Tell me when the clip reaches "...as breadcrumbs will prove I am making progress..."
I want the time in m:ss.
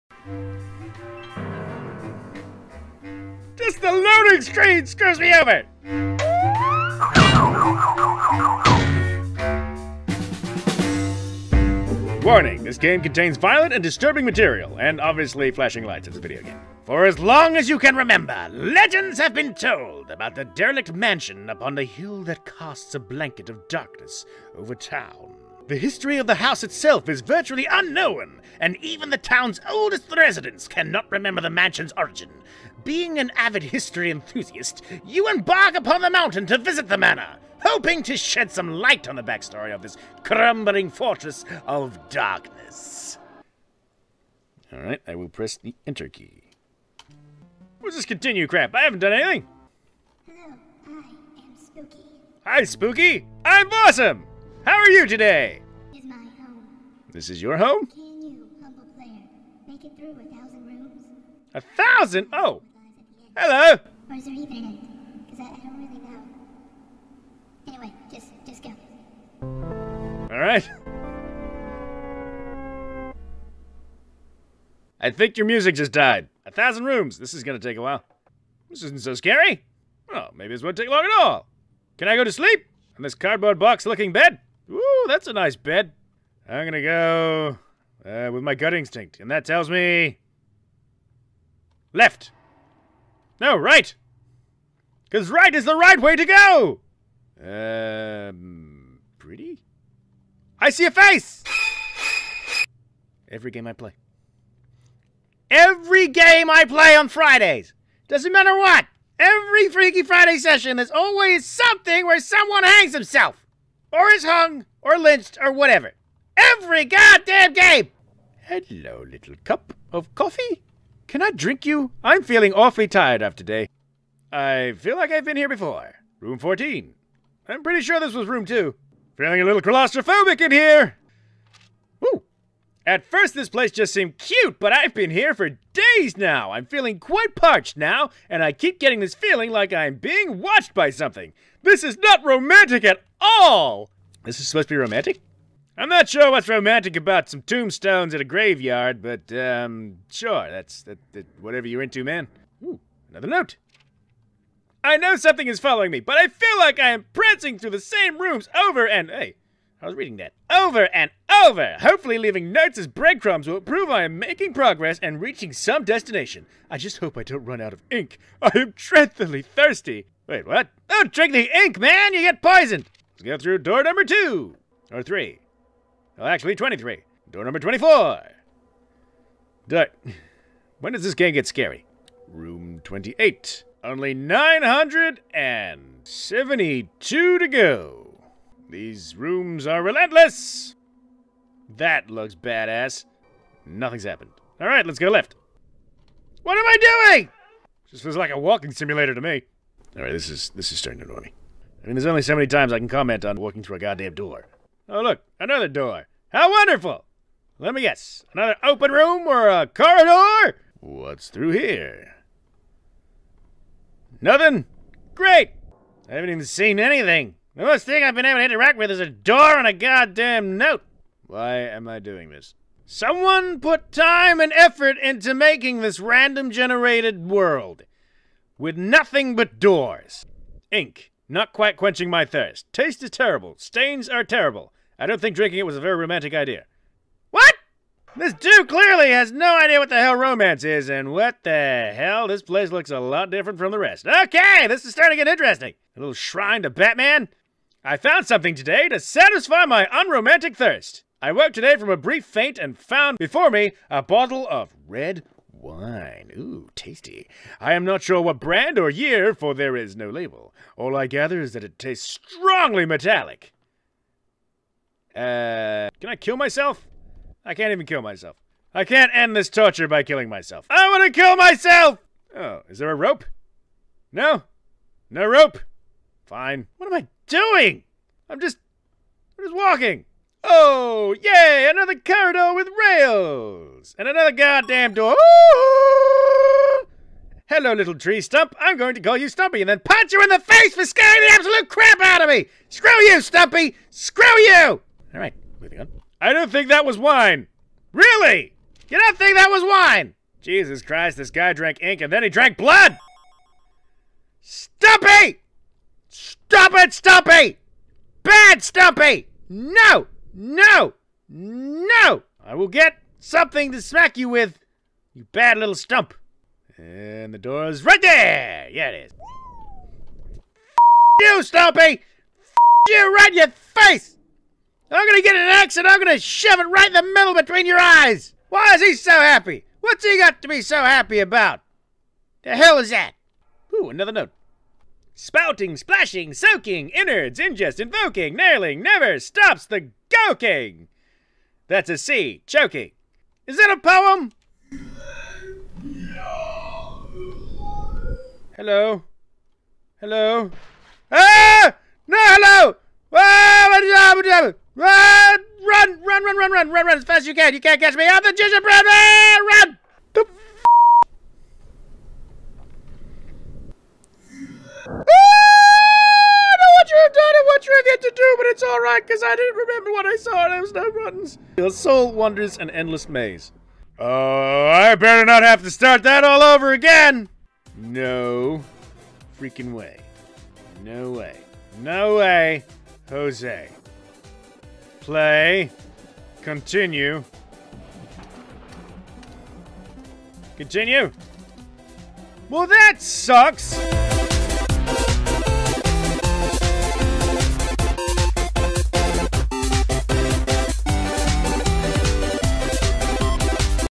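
2:42.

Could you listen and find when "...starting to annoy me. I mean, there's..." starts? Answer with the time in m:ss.
3:20.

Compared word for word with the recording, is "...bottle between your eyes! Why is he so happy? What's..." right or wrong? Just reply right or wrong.
wrong.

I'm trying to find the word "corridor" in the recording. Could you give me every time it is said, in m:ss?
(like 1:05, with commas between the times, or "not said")
3:29, 4:41.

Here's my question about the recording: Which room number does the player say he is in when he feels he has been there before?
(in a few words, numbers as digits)
14.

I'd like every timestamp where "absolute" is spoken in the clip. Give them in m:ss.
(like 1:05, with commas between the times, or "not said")
4:51.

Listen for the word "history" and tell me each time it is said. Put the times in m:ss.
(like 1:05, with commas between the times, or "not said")
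0:25, 0:33.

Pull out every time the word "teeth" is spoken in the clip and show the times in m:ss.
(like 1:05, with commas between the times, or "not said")
not said.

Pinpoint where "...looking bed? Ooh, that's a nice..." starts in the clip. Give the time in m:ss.
1:23.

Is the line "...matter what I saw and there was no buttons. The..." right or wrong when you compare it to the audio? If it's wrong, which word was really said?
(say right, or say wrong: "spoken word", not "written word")
wrong: "remember", not "matter".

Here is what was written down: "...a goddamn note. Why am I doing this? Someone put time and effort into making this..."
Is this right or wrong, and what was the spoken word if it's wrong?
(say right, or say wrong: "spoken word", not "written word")
right.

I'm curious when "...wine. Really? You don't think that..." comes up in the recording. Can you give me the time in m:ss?
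4:56.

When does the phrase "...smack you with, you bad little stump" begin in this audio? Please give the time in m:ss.
5:13.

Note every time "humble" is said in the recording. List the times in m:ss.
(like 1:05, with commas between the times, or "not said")
0:58.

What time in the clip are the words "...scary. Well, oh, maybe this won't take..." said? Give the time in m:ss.
1:19.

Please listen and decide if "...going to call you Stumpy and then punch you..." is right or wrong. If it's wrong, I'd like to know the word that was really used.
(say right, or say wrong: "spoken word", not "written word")
right.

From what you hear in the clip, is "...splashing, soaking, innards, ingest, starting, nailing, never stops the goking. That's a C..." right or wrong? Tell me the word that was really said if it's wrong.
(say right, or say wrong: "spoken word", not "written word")
wrong: "invoking", not "starting".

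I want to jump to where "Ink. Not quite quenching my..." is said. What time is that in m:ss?
3:50.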